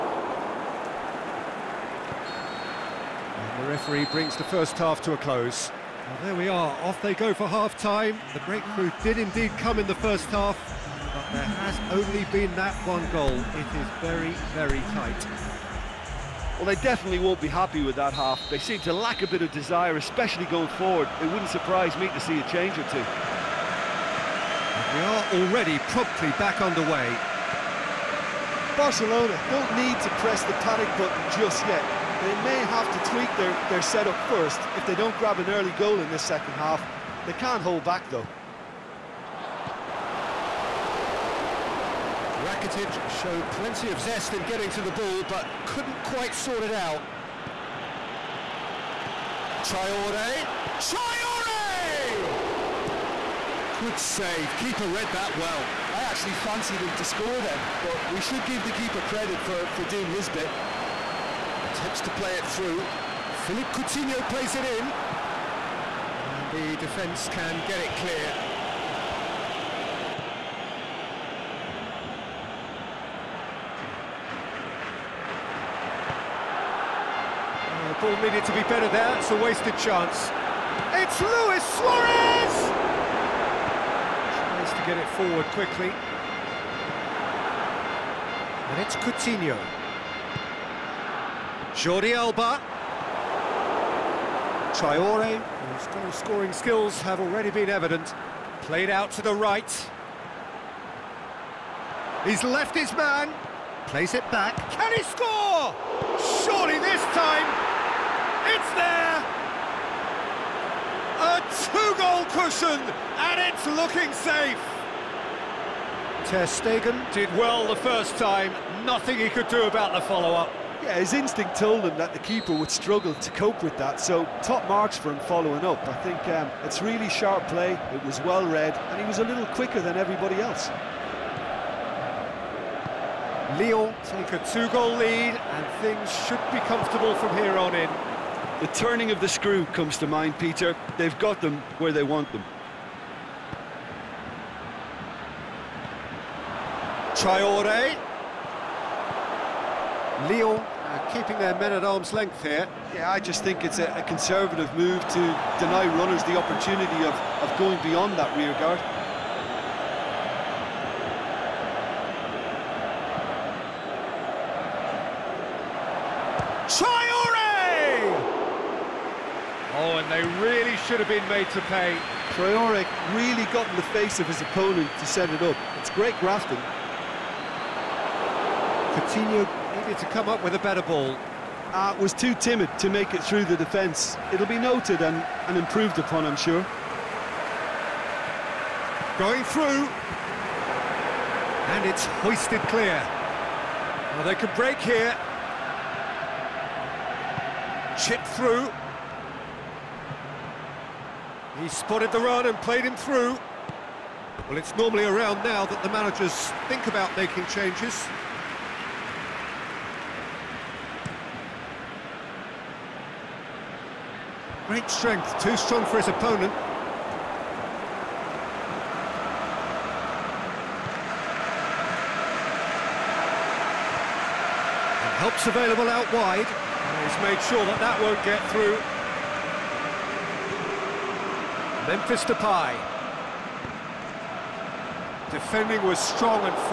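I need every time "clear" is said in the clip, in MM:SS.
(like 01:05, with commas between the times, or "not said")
01:07, 03:12.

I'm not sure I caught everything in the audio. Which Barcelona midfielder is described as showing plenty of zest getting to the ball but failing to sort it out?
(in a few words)
Rakitic.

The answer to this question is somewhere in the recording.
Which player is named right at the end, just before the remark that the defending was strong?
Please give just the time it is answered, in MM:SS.
03:51.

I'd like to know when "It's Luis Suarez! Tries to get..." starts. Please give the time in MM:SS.
01:20.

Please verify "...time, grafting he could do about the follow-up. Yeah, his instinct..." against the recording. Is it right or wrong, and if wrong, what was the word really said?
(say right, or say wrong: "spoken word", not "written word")
wrong: "nothing", not "grafting".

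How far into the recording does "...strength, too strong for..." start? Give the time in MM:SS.
03:34.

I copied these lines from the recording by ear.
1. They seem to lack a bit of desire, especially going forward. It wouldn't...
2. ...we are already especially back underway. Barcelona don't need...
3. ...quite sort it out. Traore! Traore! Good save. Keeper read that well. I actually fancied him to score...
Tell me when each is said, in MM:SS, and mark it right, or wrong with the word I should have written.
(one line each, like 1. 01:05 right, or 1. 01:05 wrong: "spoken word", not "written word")
1. 00:18 right
2. 00:24 wrong: "promptly", not "especially"
3. 00:46 right.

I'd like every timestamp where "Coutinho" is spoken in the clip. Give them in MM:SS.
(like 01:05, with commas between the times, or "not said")
01:03, 01:28, 02:58.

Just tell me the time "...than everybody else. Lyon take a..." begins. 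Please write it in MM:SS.
02:09.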